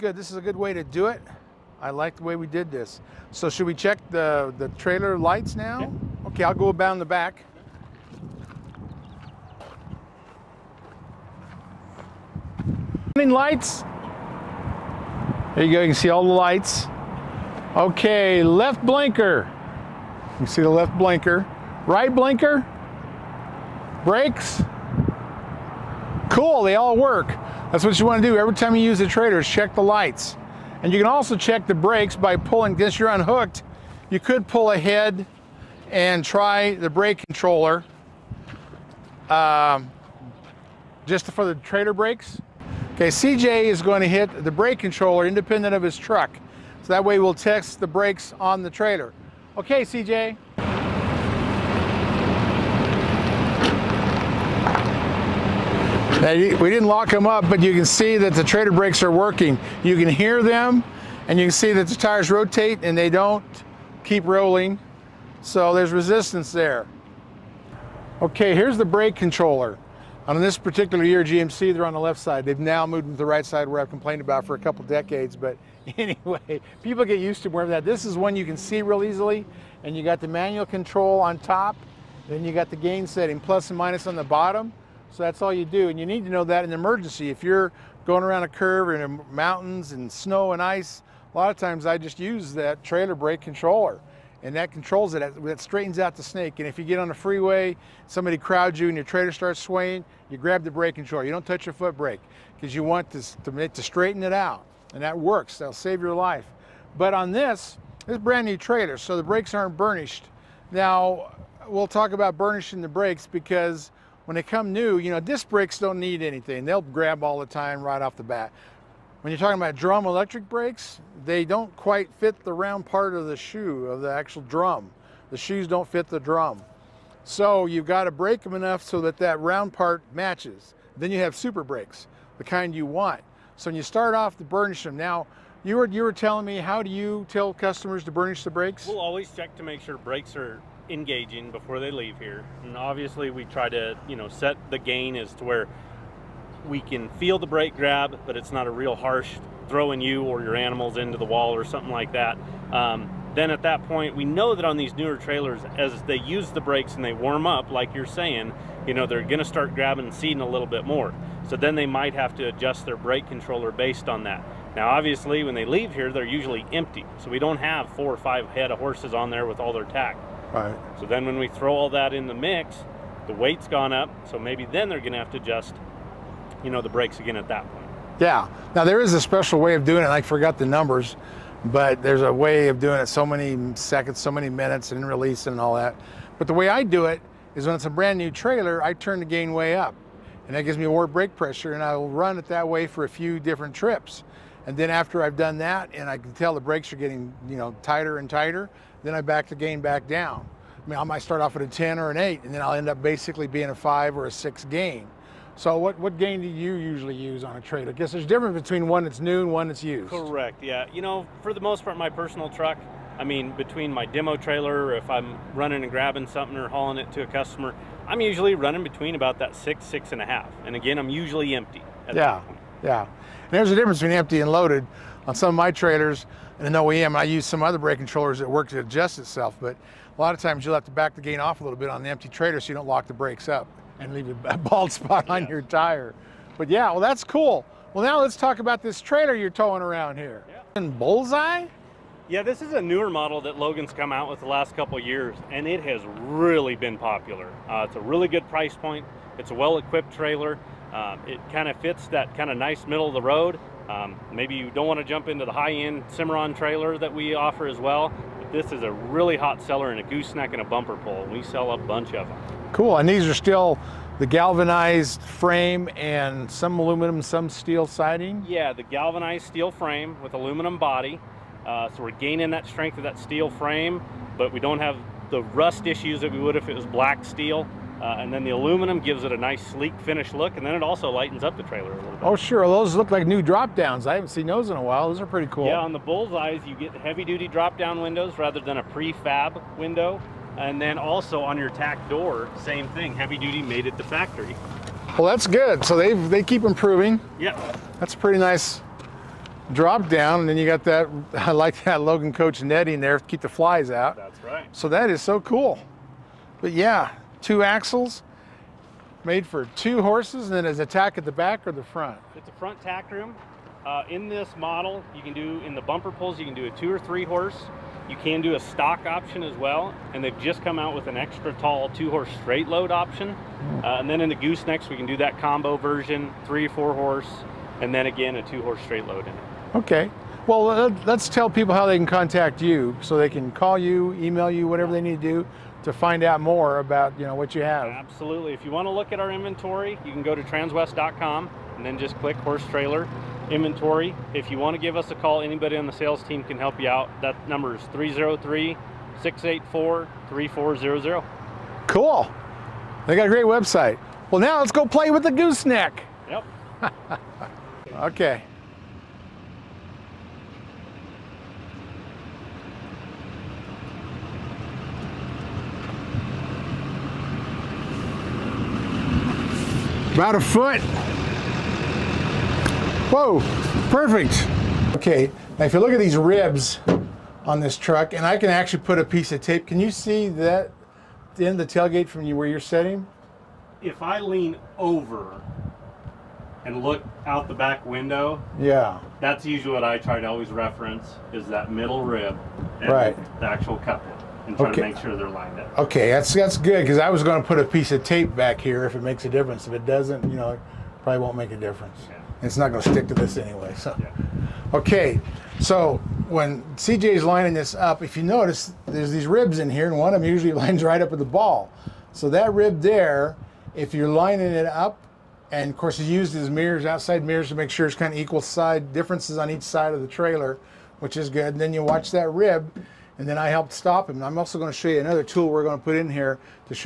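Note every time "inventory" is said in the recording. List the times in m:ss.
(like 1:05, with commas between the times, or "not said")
5:39, 5:43.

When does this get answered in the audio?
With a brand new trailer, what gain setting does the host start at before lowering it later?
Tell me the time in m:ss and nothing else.
3:21.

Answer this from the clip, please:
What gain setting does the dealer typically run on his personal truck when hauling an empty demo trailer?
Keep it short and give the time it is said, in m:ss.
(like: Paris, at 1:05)
6 to 6.5, at 3:39.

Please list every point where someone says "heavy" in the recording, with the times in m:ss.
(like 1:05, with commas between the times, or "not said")
4:46, 4:53.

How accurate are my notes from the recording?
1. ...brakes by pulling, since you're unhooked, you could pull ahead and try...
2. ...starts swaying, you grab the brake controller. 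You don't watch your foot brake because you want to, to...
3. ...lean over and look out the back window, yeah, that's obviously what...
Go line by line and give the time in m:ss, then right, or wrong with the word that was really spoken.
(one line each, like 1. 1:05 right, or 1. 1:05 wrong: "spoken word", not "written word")
1. 0:31 right
2. 1:39 wrong: "touch", not "watch"
3. 6:24 wrong: "usually", not "obviously".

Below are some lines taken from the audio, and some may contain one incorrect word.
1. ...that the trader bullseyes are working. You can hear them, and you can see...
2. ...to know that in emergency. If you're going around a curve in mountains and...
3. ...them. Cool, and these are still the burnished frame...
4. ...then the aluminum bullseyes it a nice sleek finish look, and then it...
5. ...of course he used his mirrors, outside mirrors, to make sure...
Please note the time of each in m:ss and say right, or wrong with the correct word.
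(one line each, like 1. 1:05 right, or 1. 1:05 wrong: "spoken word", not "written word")
1. 0:58 wrong: "brakes", not "bullseyes"
2. 1:26 right
3. 4:22 wrong: "galvanized", not "burnished"
4. 4:38 wrong: "gives", not "bullseyes"
5. 6:55 right.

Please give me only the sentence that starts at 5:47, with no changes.
That number is 303 684 3400.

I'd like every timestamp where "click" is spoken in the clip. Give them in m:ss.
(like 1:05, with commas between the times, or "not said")
5:42.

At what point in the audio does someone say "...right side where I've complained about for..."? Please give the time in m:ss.
1:13.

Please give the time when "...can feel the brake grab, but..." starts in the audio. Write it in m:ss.
2:26.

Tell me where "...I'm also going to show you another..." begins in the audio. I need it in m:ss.
7:04.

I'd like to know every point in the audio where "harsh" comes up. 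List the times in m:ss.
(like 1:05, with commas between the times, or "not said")
2:28.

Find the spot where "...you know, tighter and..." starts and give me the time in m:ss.
3:17.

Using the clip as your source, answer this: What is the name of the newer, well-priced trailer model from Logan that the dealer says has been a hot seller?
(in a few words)
Bullseye.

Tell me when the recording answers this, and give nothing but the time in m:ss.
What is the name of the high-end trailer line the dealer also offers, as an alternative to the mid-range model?
4:16.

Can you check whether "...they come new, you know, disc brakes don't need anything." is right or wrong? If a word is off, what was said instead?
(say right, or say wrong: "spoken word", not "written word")
right.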